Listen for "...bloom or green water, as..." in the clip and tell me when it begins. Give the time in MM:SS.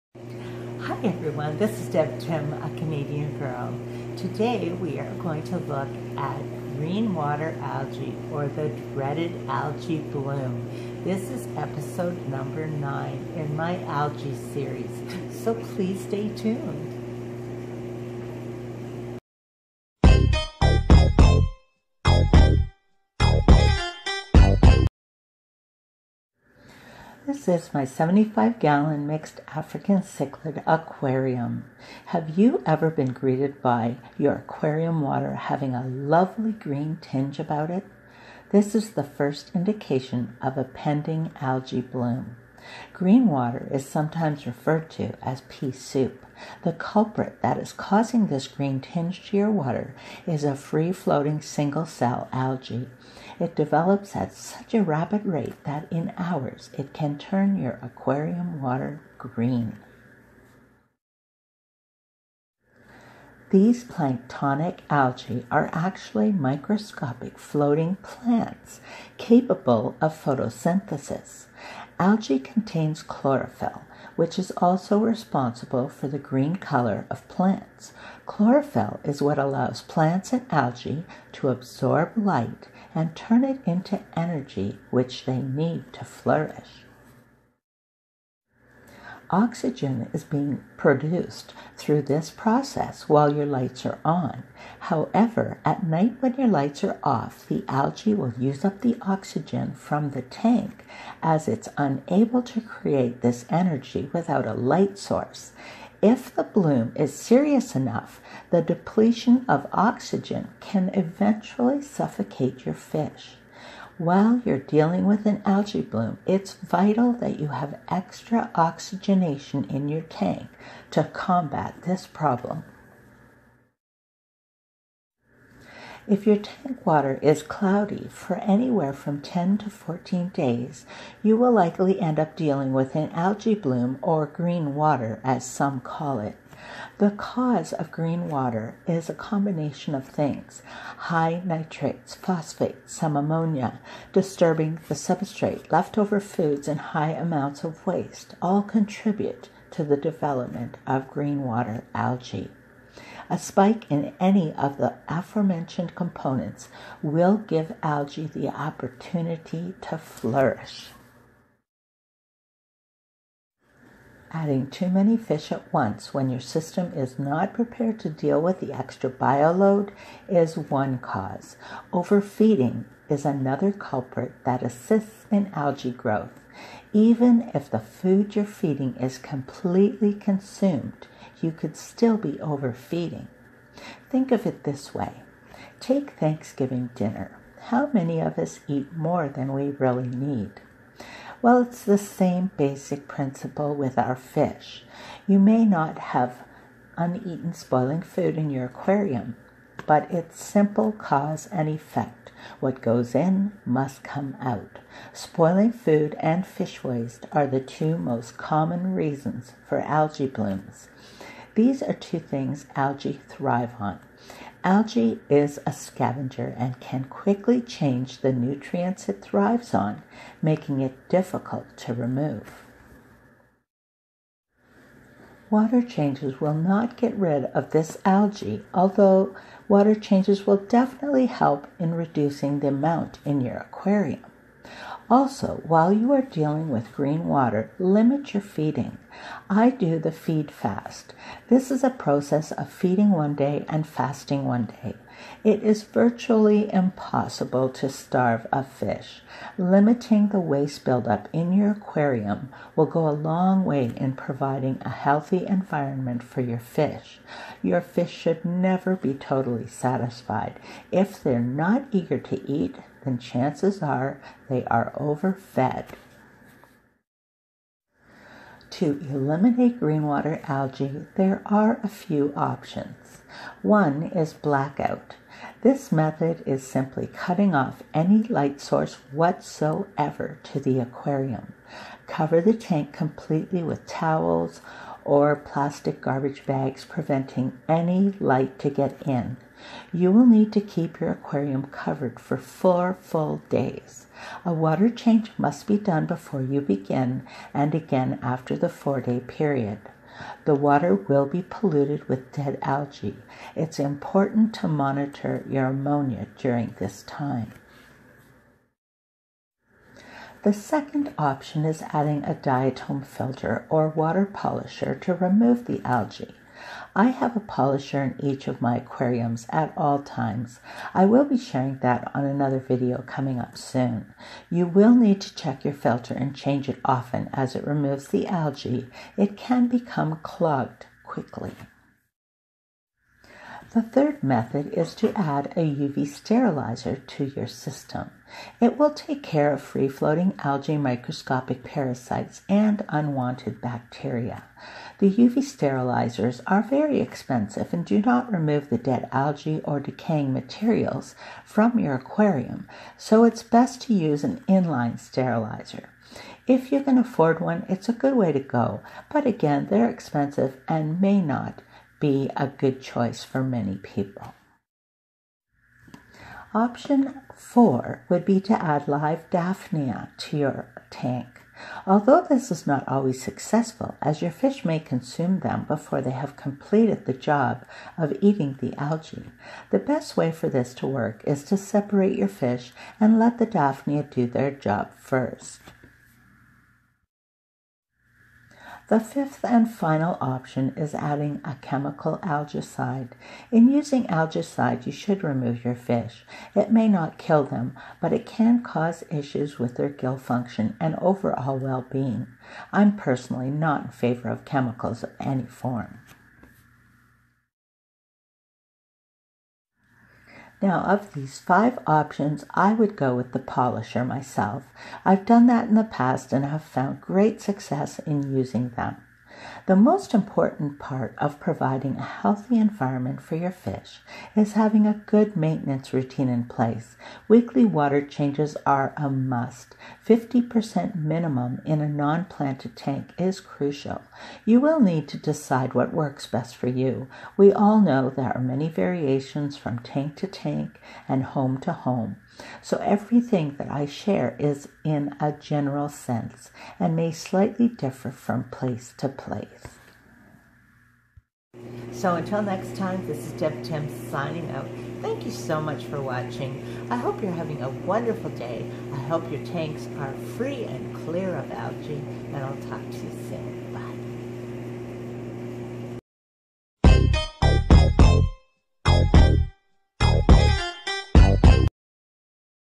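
02:13.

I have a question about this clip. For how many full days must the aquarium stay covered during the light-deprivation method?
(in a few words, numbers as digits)
4.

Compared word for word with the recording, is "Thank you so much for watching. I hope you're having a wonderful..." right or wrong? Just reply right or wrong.
right.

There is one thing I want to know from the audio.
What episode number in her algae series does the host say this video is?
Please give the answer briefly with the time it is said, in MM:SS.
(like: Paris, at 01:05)
9, at 00:12.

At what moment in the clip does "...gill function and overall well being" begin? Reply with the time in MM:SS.
06:39.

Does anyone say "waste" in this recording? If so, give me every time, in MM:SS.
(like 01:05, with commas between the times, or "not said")
02:27, 03:26, 04:10.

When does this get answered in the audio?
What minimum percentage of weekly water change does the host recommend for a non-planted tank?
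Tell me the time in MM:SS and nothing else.
07:10.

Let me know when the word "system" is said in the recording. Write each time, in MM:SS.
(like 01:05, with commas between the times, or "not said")
02:46, 05:37.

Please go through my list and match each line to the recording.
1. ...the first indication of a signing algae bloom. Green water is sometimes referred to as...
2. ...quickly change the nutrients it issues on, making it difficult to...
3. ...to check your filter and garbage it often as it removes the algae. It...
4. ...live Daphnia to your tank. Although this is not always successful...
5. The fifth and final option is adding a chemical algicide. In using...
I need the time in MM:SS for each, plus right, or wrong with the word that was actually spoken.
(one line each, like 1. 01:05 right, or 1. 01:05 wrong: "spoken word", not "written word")
1. 00:38 wrong: "pending", not "signing"
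2. 03:37 wrong: "thrives", not "issues"
3. 05:25 wrong: "change", not "garbage"
4. 06:08 right
5. 06:28 right.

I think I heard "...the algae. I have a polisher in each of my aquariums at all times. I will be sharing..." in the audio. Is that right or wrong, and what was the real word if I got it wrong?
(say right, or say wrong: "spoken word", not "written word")
right.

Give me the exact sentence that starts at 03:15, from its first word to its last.
You may not have uneaten spoiling food in your aquarium, but it's simple cause and effect.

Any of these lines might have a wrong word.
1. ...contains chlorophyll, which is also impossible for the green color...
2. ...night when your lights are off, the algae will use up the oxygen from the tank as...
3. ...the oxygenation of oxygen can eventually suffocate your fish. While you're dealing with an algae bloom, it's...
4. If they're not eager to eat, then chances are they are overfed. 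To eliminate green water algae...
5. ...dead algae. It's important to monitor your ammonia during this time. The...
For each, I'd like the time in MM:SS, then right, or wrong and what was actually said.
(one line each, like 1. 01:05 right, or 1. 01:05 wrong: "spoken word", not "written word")
1. 01:12 wrong: "responsible", not "impossible"
2. 01:35 right
3. 01:48 wrong: "depletion", not "oxygenation"
4. 04:20 right
5. 05:02 right.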